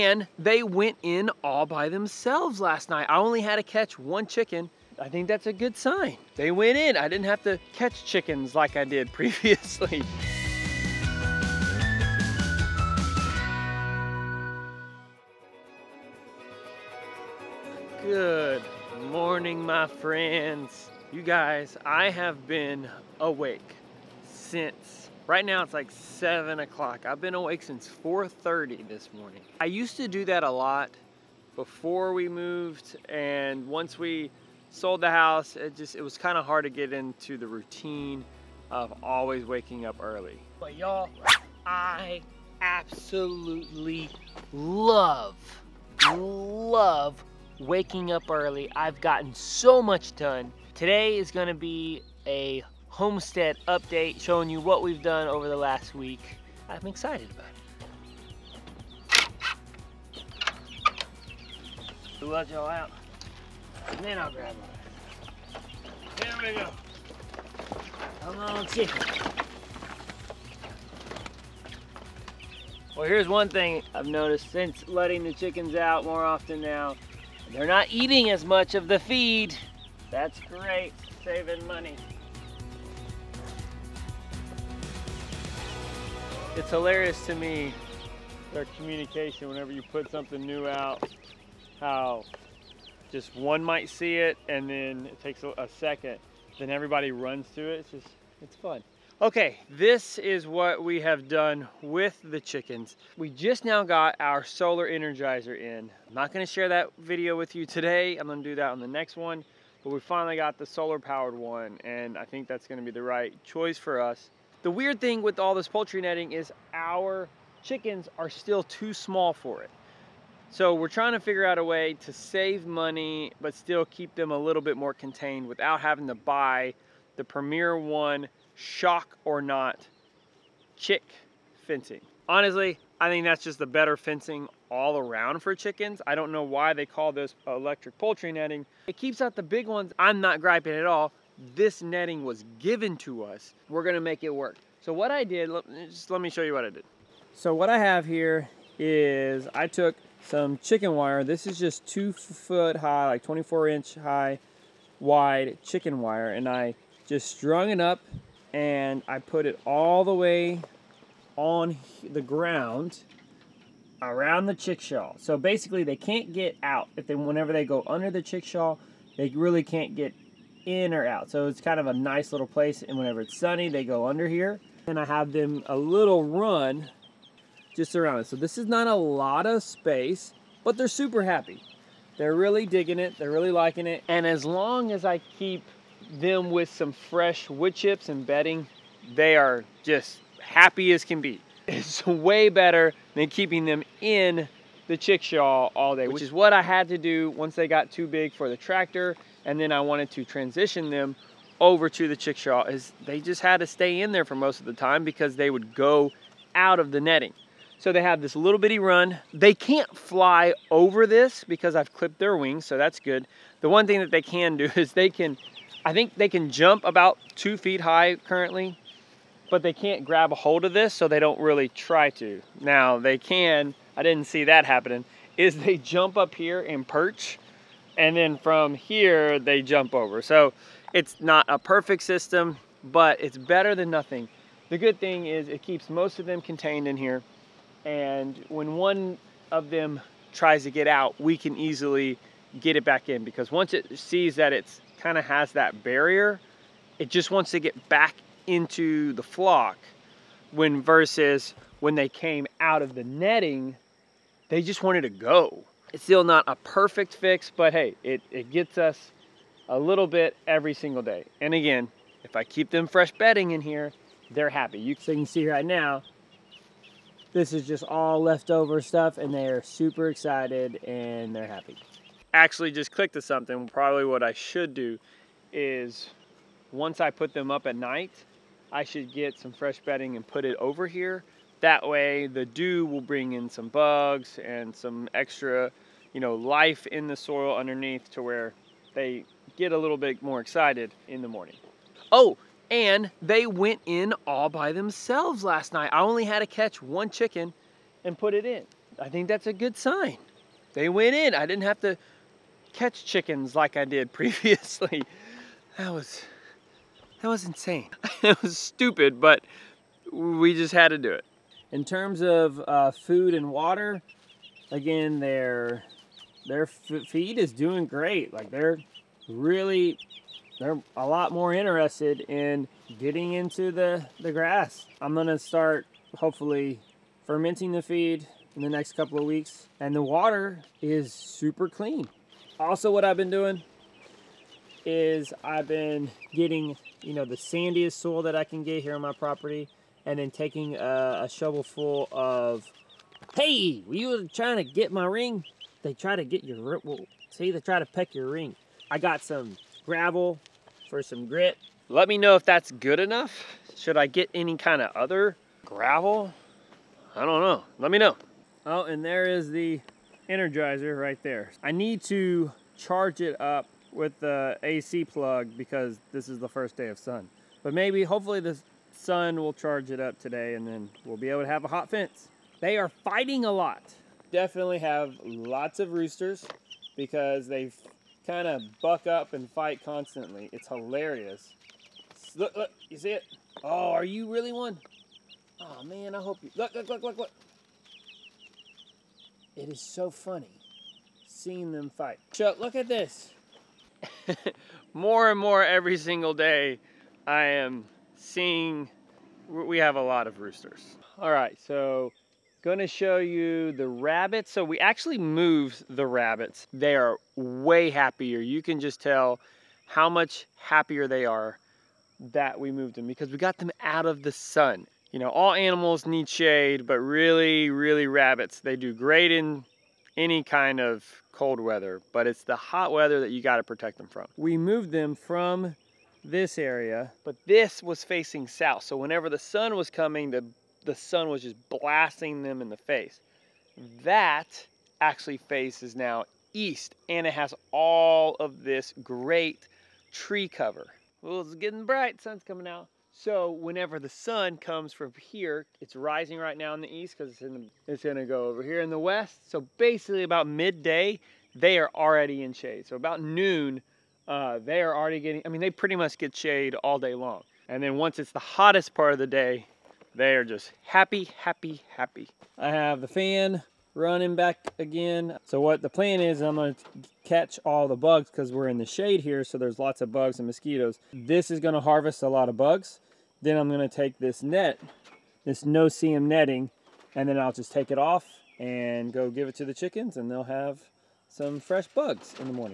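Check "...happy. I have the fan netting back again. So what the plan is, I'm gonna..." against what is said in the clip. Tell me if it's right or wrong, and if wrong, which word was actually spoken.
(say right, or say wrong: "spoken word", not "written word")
wrong: "running", not "netting".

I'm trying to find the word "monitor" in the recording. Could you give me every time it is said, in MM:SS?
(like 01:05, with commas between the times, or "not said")
not said.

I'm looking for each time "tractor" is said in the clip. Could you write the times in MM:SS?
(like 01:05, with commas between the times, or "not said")
03:18.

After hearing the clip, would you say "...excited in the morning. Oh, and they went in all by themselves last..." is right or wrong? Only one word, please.
right.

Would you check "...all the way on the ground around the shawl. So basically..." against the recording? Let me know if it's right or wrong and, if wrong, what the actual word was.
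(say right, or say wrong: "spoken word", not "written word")
right.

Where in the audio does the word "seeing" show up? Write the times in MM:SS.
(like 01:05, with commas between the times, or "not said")
06:31, 06:38.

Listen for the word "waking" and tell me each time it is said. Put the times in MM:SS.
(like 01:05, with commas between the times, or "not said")
00:39, 00:47.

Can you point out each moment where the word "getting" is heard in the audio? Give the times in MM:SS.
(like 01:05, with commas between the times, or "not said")
05:22, 05:36, 07:21, 07:35.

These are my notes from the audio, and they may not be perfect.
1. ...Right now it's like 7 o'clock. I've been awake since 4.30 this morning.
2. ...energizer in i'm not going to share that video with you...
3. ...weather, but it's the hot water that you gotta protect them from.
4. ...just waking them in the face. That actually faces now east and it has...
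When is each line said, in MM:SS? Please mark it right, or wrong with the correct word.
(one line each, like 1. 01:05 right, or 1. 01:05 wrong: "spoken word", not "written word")
1. 00:25 right
2. 01:44 right
3. 07:01 wrong: "weather", not "water"
4. 07:11 wrong: "blasting", not "waking".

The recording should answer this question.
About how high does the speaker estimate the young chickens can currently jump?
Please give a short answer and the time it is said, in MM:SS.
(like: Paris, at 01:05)
about two feet, at 03:36.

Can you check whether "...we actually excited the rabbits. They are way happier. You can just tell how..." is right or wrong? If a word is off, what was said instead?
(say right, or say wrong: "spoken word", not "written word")
wrong: "moved", not "excited".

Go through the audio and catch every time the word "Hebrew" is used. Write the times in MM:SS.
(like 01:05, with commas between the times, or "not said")
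not said.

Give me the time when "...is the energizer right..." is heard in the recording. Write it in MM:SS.
05:59.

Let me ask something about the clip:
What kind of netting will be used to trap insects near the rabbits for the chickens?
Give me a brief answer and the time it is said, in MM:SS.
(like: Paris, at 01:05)
No-see-um netting, at 07:55.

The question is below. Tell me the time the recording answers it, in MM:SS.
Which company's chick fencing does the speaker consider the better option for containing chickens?
02:07.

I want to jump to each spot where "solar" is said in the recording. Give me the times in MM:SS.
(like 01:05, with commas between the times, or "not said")
01:44, 01:50.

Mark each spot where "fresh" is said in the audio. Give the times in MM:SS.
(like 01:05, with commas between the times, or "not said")
03:06, 04:22, 04:39, 08:01.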